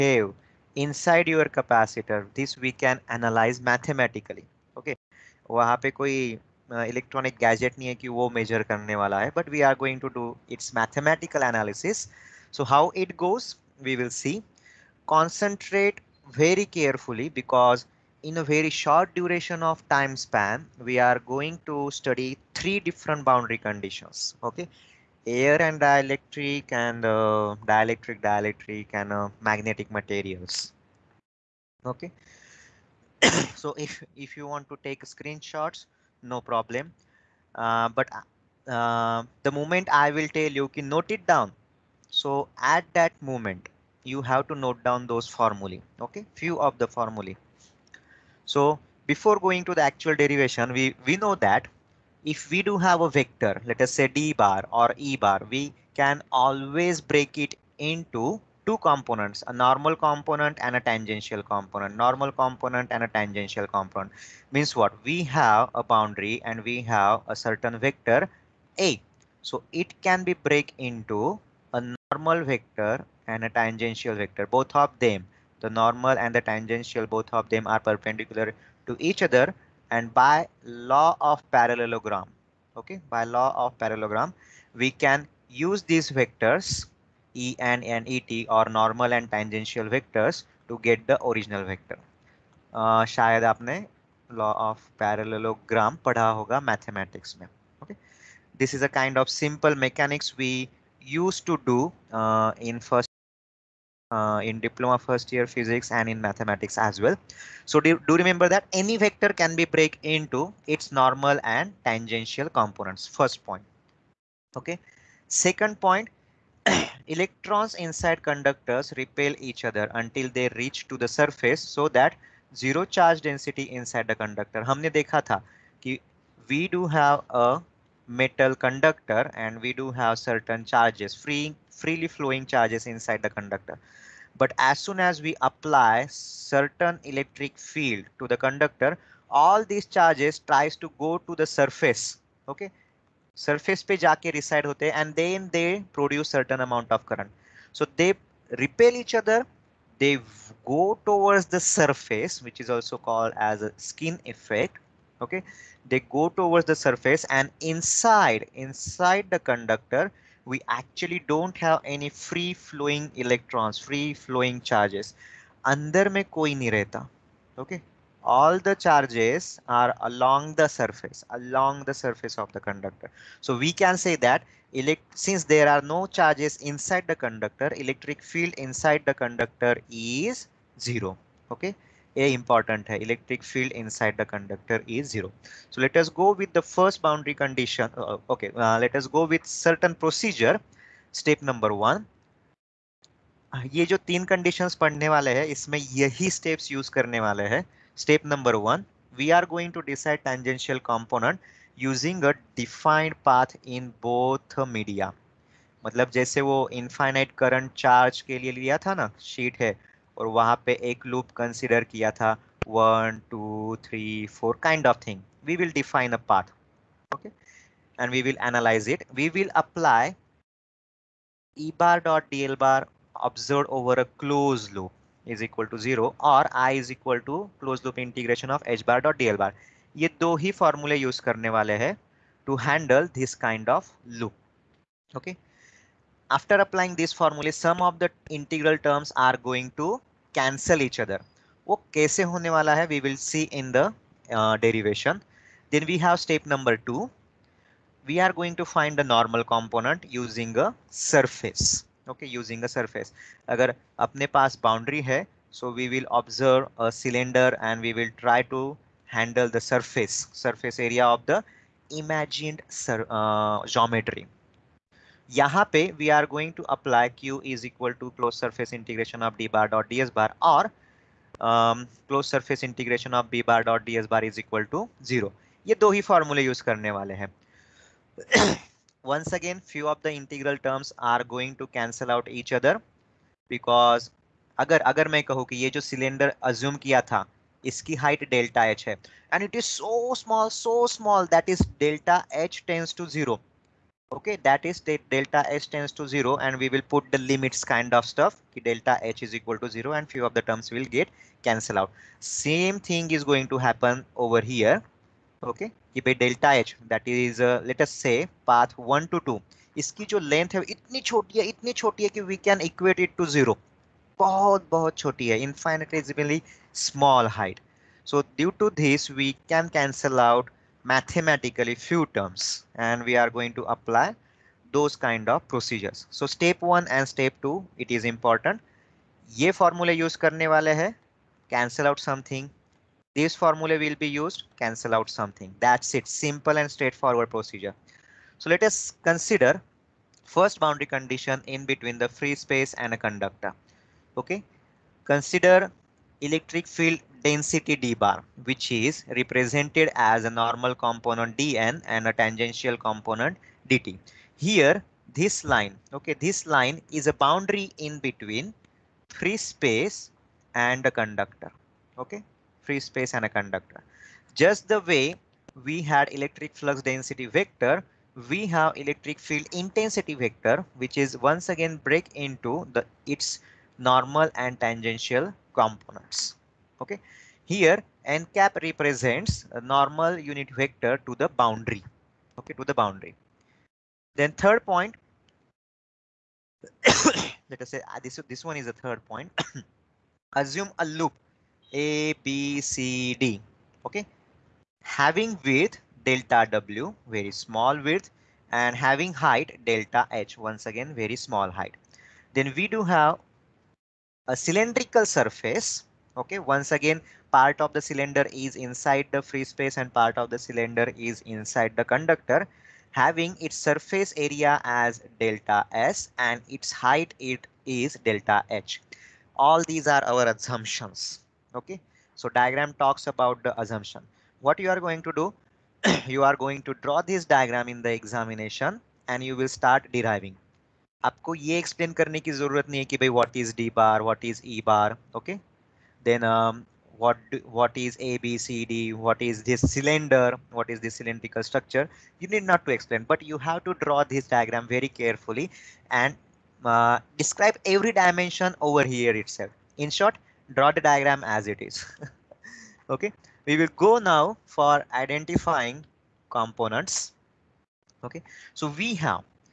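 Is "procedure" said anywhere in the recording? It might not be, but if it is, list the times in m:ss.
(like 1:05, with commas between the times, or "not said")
3:09, 5:25, 5:37.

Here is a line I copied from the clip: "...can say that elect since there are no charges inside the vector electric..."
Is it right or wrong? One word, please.
wrong.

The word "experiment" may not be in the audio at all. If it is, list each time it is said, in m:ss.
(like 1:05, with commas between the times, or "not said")
not said.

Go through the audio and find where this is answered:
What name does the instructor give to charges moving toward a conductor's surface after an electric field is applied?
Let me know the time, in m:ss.
2:33.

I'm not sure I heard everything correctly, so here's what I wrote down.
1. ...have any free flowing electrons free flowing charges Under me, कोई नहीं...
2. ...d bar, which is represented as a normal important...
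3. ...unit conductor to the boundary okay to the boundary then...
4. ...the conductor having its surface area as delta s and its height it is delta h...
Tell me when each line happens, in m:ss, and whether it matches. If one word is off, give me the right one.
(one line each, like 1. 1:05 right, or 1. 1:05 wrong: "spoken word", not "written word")
1. 2:41 right
2. 5:47 wrong: "component", not "important"
3. 6:20 wrong: "vector", not "conductor"
4. 6:51 right.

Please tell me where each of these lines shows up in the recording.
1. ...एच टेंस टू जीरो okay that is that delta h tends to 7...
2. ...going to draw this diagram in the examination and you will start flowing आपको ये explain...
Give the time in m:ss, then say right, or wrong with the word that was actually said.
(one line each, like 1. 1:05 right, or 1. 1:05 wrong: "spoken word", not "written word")
1. 4:52 wrong: "0", not "7"
2. 7:06 wrong: "deriving", not "flowing".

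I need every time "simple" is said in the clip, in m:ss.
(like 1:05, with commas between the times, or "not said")
1:39, 5:36.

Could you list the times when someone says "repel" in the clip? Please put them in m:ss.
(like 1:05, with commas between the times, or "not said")
1:58, 2:28.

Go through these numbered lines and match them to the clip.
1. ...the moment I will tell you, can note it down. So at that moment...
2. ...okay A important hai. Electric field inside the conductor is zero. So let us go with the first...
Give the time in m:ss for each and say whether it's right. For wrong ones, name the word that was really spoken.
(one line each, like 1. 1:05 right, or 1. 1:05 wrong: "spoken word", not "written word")
1. 0:39 right
2. 3:01 right.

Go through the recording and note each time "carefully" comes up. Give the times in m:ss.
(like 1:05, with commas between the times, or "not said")
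0:16, 7:24.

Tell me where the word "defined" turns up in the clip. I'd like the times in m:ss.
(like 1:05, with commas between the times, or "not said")
3:22.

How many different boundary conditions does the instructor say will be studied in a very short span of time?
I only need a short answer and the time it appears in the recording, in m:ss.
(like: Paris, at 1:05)
3, at 0:22.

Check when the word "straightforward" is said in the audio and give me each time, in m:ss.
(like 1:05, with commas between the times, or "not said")
5:36.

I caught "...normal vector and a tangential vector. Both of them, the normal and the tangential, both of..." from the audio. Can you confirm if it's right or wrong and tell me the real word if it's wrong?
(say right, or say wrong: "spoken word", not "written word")
right.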